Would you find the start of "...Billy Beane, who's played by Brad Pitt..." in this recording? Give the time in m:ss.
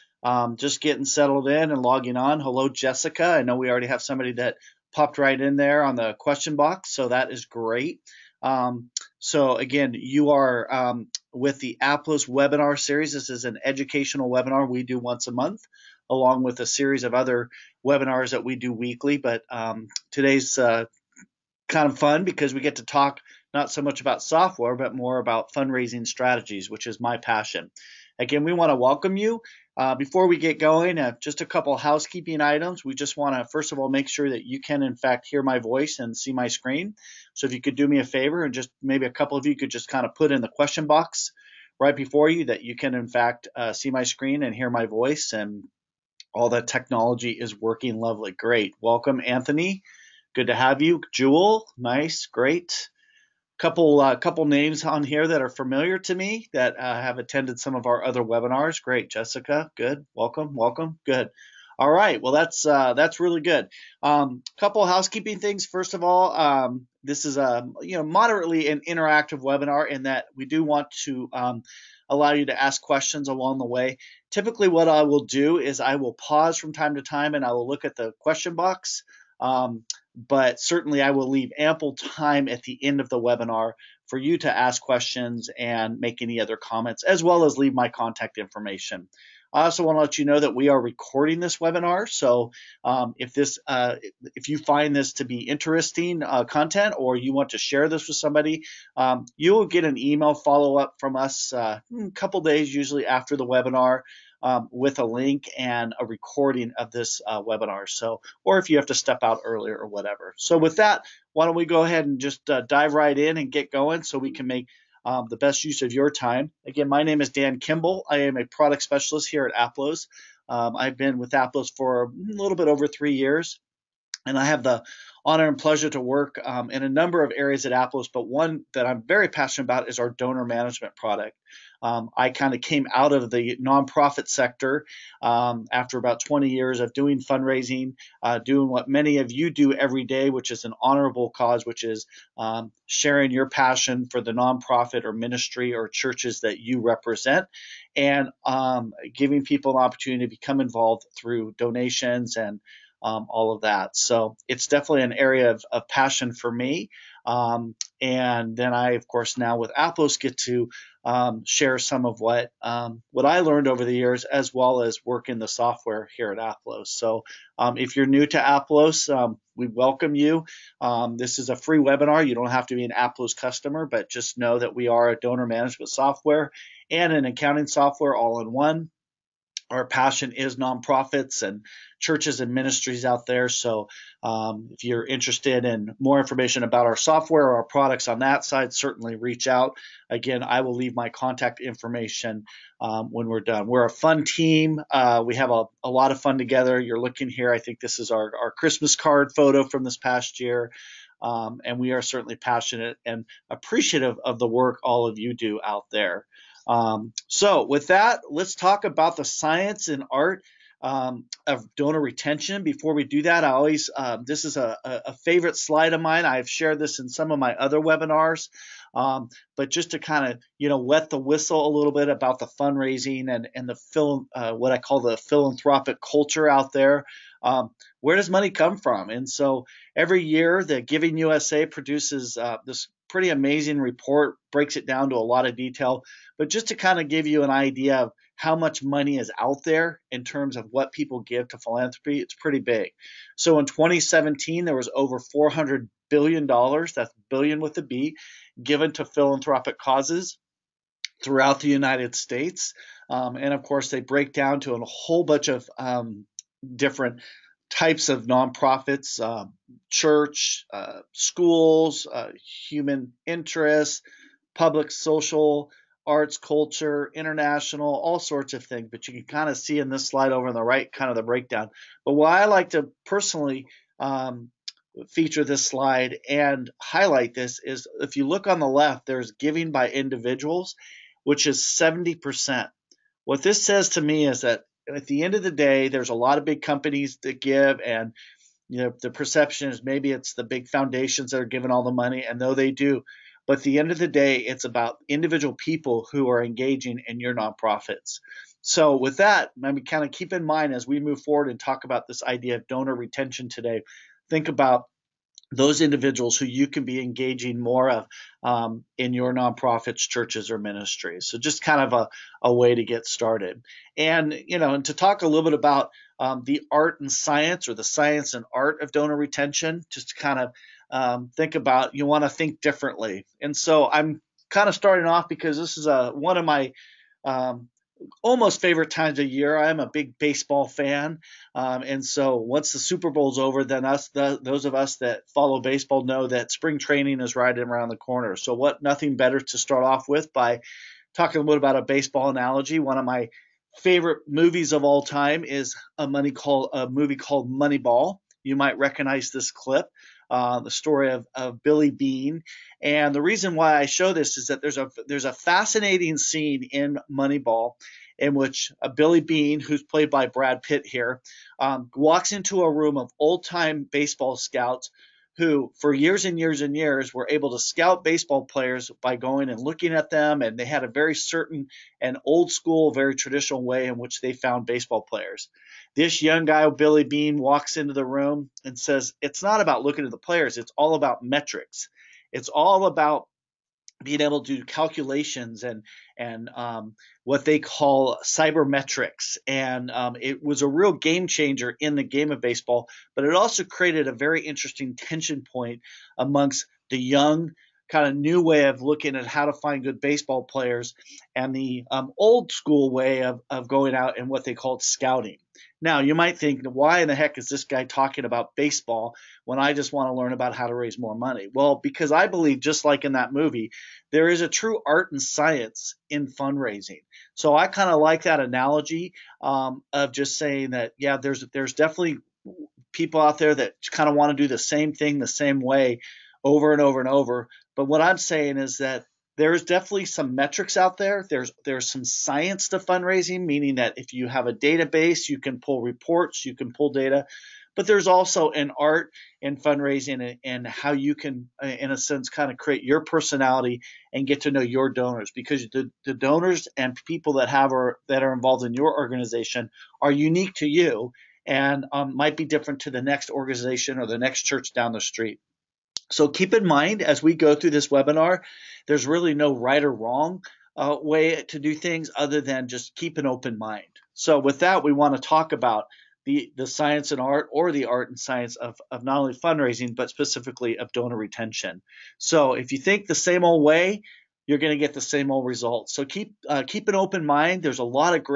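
5:58.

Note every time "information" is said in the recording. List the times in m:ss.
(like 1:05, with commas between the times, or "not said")
1:28, 3:06, 3:11.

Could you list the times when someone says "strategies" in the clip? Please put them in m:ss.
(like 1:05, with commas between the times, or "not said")
0:26.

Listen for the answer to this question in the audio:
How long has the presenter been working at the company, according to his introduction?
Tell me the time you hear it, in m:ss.
2:02.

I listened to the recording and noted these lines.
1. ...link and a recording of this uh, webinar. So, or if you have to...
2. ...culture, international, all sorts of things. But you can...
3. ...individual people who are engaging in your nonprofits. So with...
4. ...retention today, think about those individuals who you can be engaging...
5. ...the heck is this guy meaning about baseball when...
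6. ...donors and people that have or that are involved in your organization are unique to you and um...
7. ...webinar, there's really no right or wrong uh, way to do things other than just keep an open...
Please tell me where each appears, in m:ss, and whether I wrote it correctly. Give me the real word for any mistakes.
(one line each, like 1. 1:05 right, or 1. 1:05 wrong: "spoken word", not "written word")
1. 1:45 right
2. 4:26 right
3. 4:55 right
4. 5:02 right
5. 6:47 wrong: "talking", not "meaning"
6. 7:26 right
7. 7:37 right.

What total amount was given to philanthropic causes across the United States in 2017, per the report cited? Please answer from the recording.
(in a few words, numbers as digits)
over 400 billion dollars.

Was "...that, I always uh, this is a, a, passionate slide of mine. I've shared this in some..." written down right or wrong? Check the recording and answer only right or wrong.
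wrong.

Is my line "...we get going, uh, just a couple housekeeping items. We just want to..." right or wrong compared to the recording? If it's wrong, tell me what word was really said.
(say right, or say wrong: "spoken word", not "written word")
right.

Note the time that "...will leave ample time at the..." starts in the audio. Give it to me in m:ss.
1:21.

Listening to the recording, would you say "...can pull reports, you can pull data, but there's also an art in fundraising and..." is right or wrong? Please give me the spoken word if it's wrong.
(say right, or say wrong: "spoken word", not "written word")
right.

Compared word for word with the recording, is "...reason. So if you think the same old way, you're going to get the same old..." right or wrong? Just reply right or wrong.
wrong.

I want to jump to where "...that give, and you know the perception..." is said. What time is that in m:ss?
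4:47.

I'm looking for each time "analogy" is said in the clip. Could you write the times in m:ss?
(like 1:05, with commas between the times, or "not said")
5:42, 6:58.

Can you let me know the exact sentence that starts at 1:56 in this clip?
Again, my name is Dan Kimball.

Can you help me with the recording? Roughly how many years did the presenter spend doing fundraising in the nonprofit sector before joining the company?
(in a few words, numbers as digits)
about 20 years.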